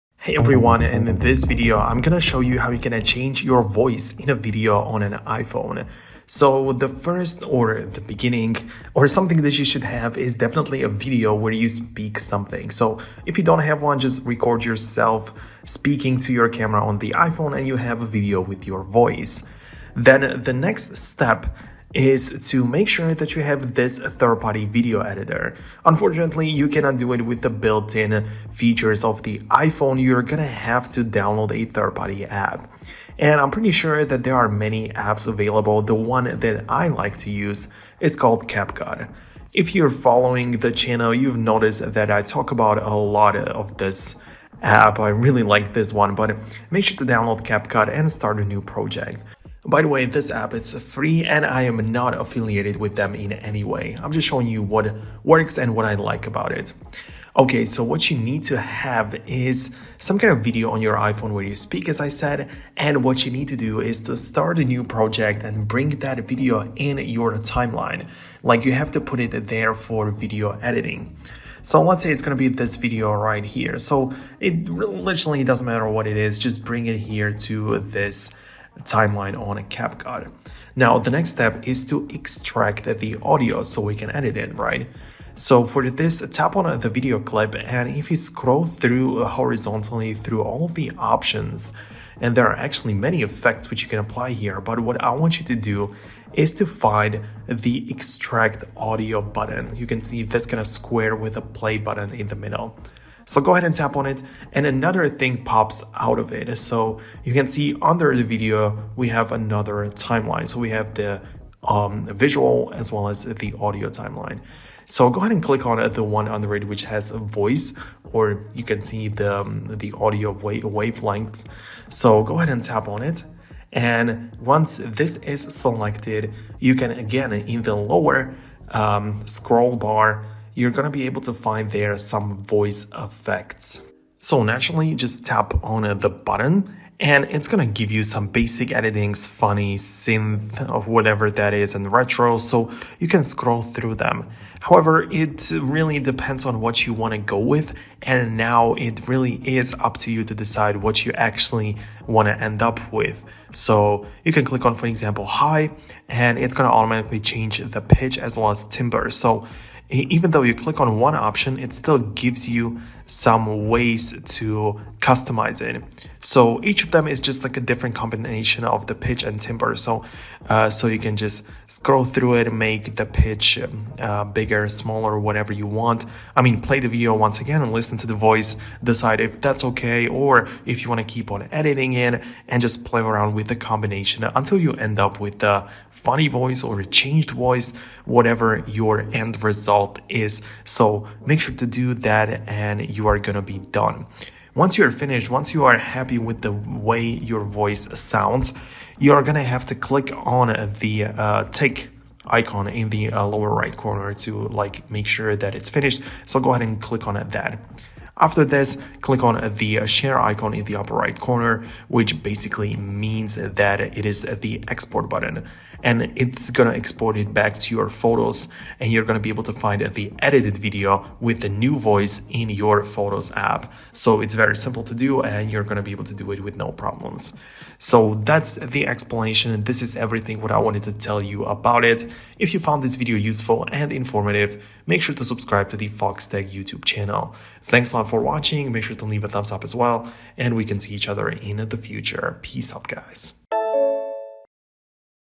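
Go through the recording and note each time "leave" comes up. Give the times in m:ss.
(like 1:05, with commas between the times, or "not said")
3:59.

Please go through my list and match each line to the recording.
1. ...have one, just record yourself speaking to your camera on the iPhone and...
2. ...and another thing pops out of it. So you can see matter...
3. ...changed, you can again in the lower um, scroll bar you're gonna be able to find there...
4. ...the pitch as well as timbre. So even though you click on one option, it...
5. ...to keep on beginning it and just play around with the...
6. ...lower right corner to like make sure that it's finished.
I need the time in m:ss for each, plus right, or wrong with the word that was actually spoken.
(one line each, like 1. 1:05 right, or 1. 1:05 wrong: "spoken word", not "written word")
1. 0:13 right
2. 1:44 wrong: "under", not "matter"
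3. 2:05 wrong: "selected", not "changed"
4. 2:37 right
5. 3:00 wrong: "editing", not "beginning"
6. 3:23 right.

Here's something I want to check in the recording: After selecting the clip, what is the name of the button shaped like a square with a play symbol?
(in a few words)
extract audio.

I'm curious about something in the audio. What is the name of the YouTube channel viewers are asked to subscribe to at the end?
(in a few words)
Foxtecc.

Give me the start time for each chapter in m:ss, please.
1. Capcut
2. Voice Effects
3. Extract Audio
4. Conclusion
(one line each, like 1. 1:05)
1. 0:22
2. 2:01
3. 1:20
4. 3:42.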